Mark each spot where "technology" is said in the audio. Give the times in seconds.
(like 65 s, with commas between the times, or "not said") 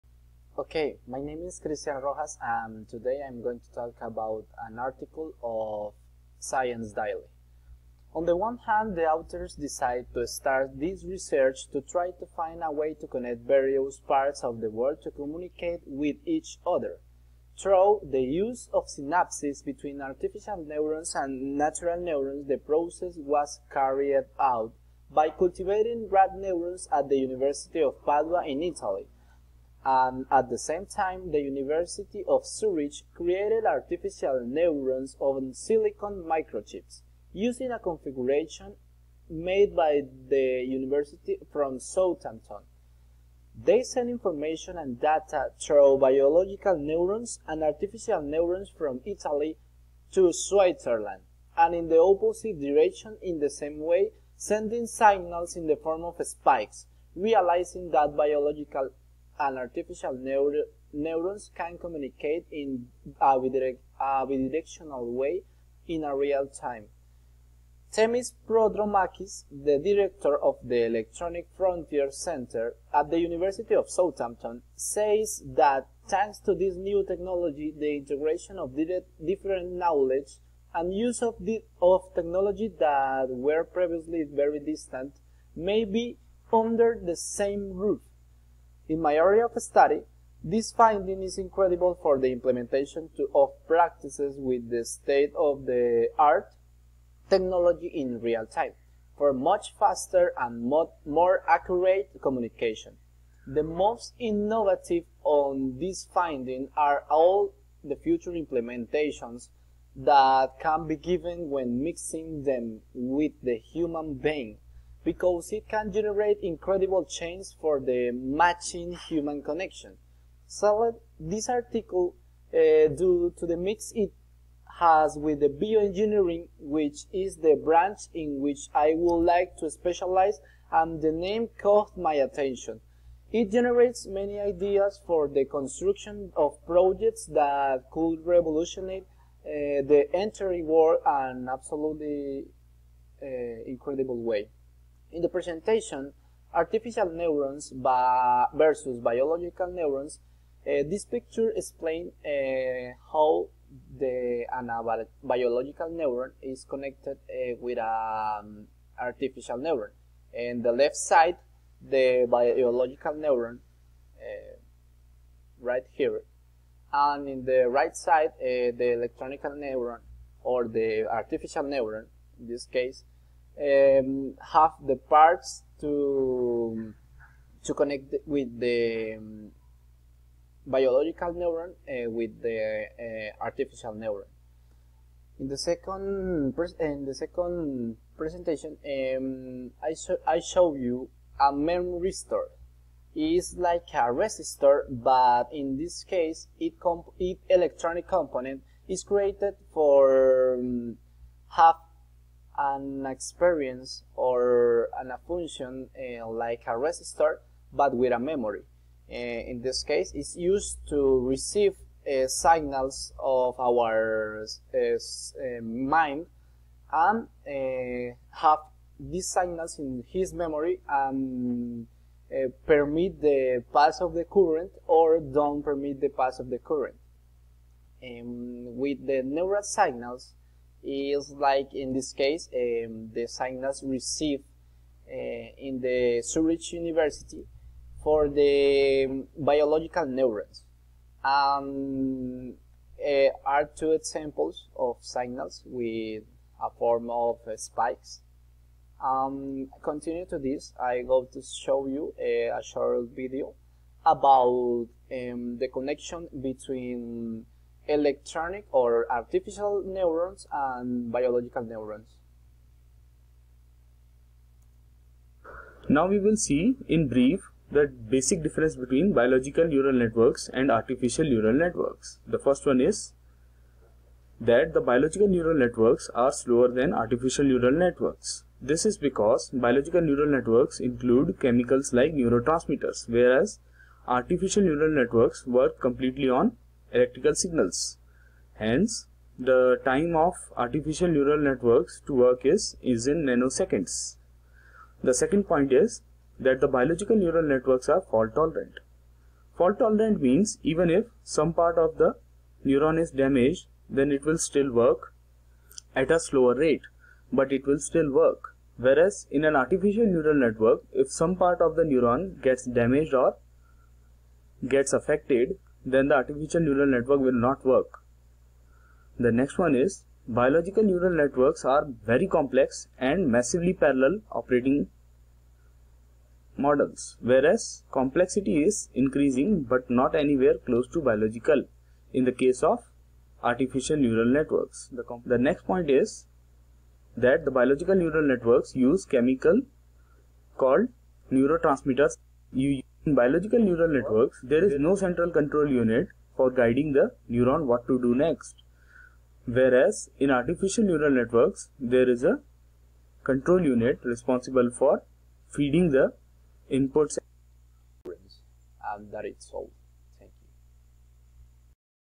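77 s, 82 s, 97 s.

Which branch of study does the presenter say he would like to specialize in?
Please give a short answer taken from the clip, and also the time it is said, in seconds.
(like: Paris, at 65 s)
bioengineering, at 125 s.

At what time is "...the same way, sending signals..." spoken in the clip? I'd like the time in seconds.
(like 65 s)
53 s.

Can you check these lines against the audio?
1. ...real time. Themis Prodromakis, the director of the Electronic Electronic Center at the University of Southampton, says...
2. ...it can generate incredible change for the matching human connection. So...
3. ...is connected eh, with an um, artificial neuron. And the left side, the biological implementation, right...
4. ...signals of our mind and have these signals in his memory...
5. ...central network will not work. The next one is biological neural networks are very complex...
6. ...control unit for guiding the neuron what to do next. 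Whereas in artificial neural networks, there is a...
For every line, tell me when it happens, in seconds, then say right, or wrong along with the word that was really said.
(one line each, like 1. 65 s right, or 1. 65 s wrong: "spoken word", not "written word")
1. 66 s wrong: "Frontier", not "Electronic"
2. 115 s right
3. 156 s wrong: "neuron", not "implementation"
4. 212 s right
5. 316 s wrong: "neural", not "central"
6. 345 s right.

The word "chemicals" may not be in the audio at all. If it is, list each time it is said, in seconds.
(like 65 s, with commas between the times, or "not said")
281 s, 339 s.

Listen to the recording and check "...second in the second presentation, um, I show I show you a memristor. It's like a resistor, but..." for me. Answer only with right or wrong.
right.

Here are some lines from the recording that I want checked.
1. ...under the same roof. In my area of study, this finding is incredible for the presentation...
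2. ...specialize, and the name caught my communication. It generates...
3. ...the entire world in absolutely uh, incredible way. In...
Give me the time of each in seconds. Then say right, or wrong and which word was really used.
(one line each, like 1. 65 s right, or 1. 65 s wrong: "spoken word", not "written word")
1. 86 s wrong: "implementation", not "presentation"
2. 129 s wrong: "attention", not "communication"
3. 139 s right.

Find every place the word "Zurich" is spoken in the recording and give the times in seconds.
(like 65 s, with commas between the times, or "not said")
32 s, 236 s.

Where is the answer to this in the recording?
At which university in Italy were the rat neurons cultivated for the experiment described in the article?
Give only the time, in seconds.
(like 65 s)
27 s.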